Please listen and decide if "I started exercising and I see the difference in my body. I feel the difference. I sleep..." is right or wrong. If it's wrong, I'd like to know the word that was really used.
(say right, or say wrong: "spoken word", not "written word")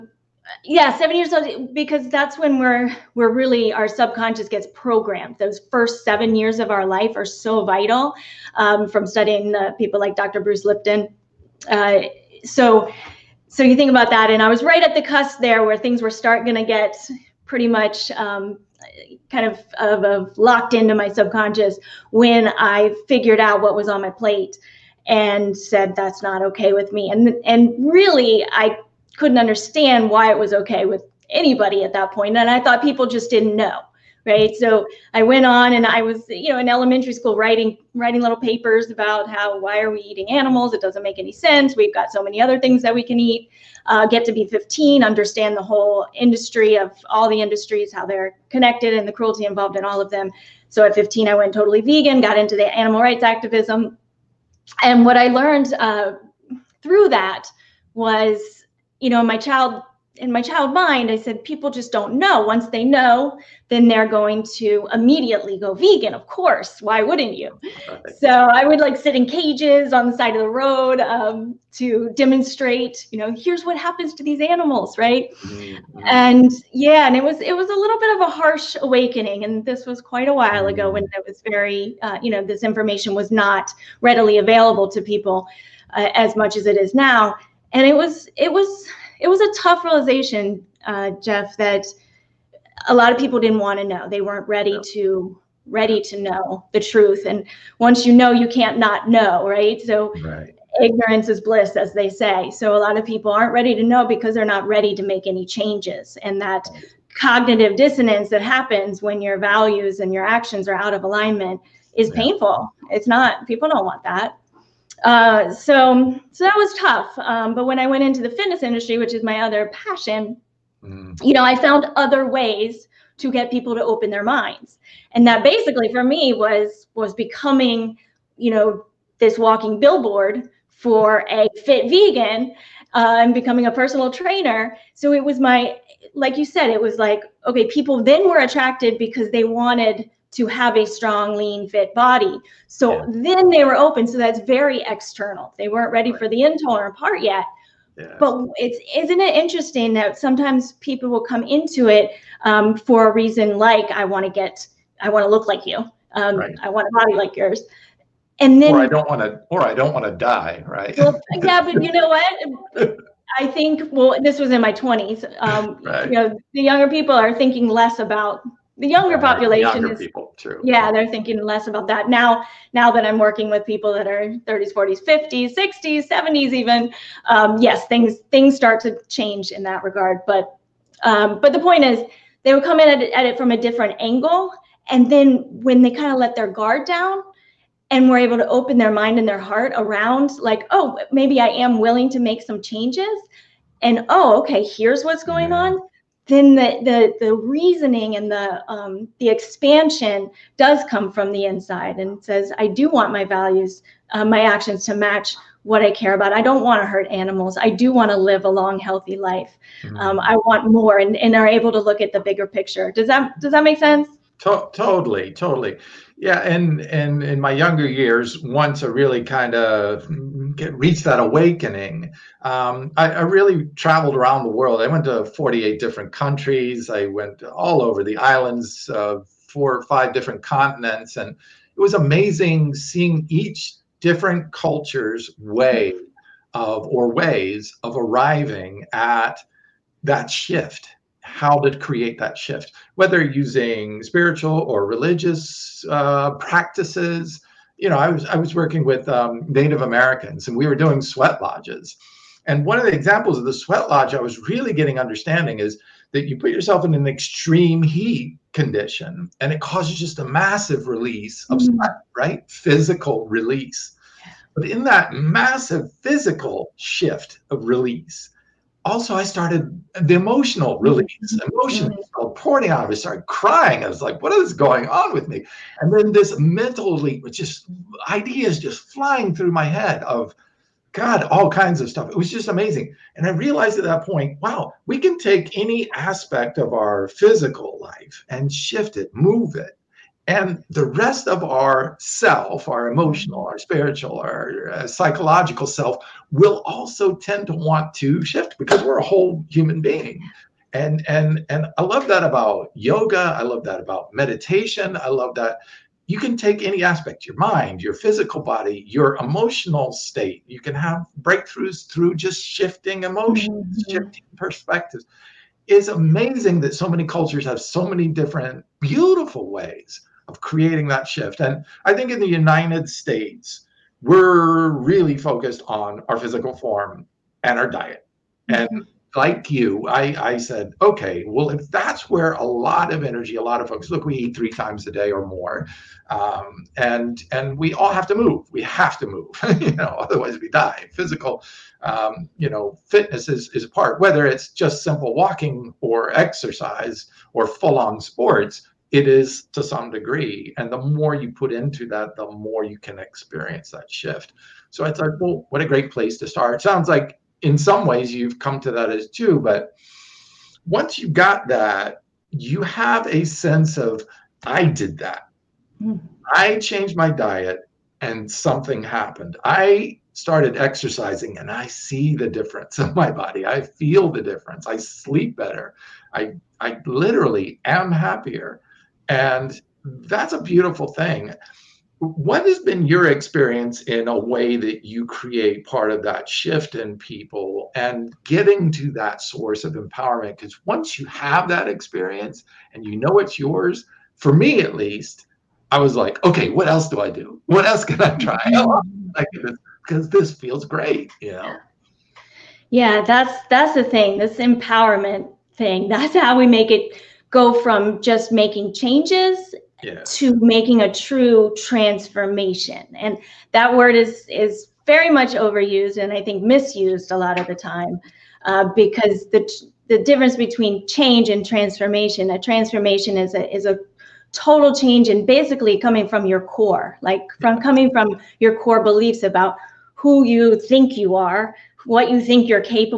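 right.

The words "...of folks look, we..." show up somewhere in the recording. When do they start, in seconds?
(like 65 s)
333 s.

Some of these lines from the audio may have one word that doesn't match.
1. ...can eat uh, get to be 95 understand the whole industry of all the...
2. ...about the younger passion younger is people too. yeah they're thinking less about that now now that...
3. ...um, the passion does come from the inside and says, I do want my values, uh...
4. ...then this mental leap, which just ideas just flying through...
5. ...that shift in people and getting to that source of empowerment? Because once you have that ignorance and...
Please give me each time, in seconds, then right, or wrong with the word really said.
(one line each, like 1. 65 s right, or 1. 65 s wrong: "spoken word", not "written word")
1. 43 s wrong: "15", not "95"
2. 167 s wrong: "population", not "passion"
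3. 198 s wrong: "expansion", not "passion"
4. 275 s right
5. 386 s wrong: "experience", not "ignorance".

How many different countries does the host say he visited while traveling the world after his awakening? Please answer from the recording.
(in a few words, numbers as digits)
48.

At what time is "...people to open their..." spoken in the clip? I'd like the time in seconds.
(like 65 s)
123 s.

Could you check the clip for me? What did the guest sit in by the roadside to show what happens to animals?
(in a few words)
cages.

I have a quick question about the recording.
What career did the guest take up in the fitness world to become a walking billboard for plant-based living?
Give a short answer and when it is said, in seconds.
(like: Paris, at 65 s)
personal trainer, at 133 s.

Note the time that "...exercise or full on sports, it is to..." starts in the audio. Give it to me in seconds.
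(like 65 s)
346 s.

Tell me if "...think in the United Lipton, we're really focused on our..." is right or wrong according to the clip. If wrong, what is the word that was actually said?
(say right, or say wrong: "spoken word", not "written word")
wrong: "States", not "Lipton".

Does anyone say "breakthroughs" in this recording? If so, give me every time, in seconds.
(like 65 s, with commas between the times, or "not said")
311 s.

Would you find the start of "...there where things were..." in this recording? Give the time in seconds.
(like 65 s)
15 s.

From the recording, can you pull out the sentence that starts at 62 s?
Once they know, then they're going to immediately go vegan.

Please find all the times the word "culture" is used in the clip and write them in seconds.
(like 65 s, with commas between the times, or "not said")
234 s, 317 s.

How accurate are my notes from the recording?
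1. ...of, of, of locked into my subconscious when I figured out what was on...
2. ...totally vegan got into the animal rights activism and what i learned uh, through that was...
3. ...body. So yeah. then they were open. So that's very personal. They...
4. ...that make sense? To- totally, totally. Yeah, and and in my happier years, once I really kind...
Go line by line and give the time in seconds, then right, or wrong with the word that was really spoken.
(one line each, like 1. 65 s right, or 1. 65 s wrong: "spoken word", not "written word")
1. 19 s right
2. 51 s right
3. 141 s wrong: "external", not "personal"
4. 213 s wrong: "younger", not "happier".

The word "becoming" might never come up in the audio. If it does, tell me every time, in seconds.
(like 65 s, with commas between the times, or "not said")
127 s, 133 s.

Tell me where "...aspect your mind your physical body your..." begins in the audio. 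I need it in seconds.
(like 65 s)
306 s.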